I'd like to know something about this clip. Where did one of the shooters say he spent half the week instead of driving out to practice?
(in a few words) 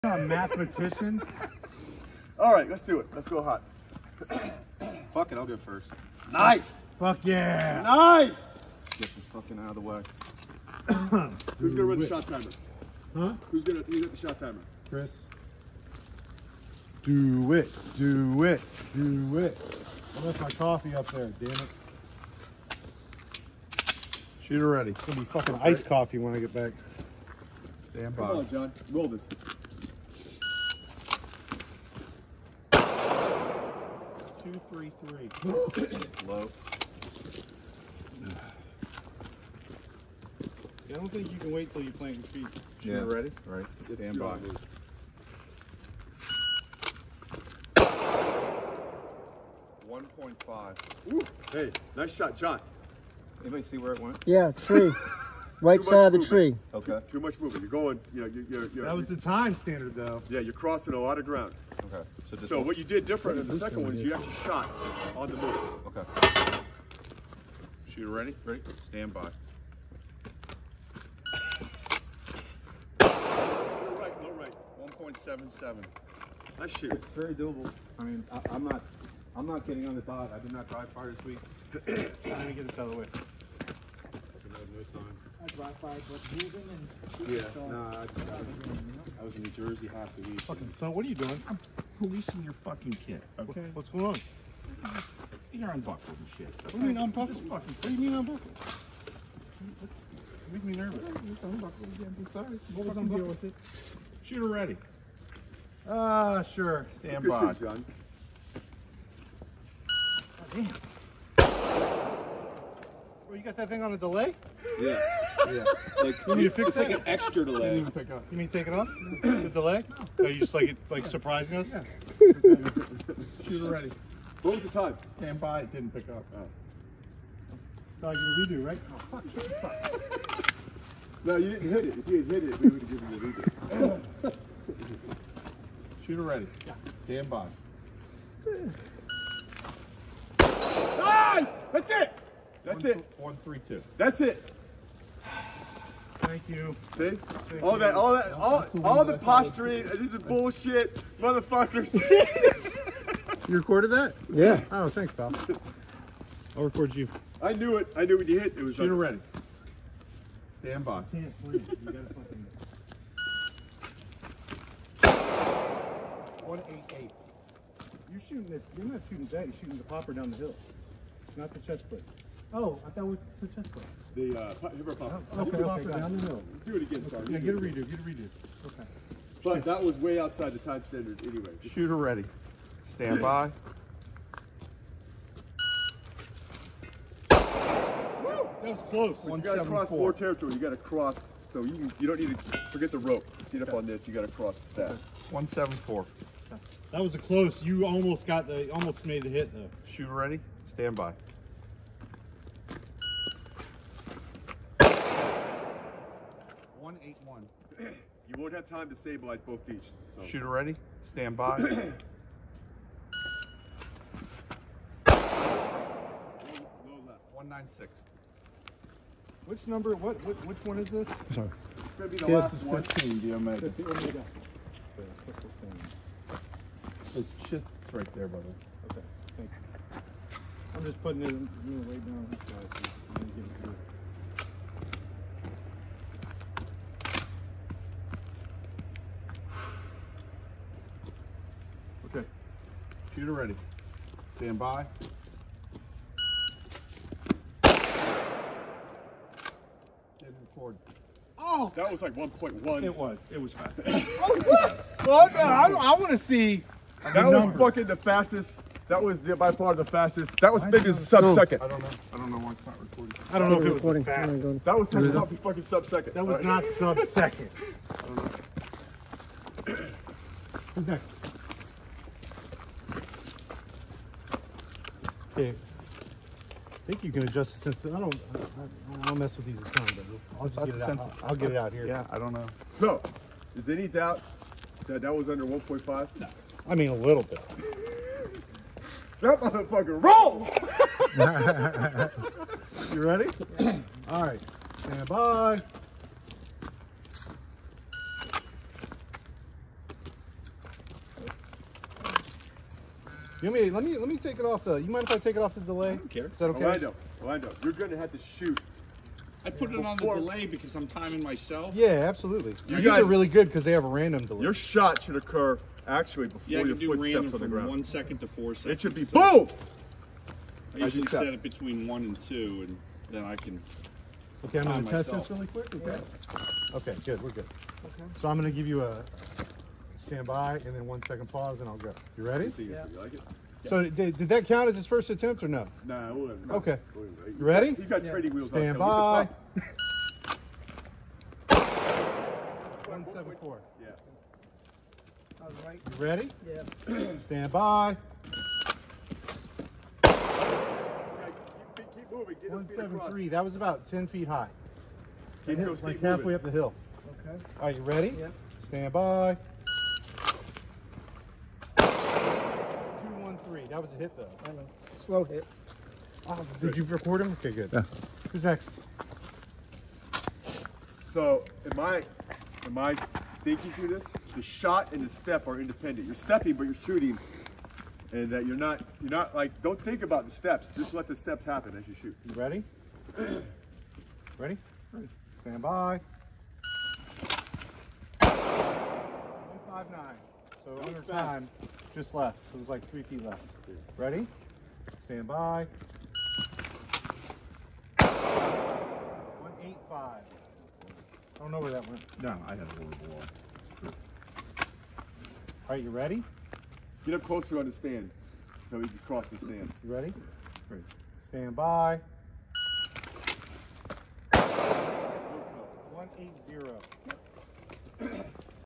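New Jersey.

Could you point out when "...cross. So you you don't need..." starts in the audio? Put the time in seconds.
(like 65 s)
190 s.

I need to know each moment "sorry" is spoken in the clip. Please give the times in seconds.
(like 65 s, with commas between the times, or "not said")
102 s, 177 s, 221 s.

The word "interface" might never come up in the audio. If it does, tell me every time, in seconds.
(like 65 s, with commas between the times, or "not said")
not said.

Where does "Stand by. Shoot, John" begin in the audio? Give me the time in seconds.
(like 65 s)
106 s.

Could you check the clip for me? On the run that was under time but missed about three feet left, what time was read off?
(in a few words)
1.59.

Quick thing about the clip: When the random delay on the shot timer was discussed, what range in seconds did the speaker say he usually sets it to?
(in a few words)
between 1 and 2.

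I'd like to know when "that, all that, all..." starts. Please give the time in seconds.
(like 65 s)
147 s.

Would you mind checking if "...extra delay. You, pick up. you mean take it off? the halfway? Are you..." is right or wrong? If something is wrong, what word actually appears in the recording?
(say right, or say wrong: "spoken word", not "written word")
wrong: "delay", not "halfway".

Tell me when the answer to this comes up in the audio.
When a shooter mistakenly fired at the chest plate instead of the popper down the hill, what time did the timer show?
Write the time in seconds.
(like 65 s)
166 s.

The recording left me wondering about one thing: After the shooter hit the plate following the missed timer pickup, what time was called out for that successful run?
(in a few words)
1.32.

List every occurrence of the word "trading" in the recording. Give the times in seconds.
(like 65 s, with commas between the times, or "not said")
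338 s.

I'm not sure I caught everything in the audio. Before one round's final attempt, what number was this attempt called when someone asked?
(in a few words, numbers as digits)
15, Omega.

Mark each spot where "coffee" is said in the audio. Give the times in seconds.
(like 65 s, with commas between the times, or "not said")
20 s, 25 s.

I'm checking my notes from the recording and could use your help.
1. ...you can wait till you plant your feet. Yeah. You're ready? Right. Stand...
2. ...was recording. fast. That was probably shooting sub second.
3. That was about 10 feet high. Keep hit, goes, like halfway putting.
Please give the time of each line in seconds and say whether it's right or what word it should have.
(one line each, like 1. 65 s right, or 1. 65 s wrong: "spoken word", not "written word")
1. 41 s right
2. 263 s wrong: "fucking", not "shooting"
3. 353 s wrong: "moving", not "putting".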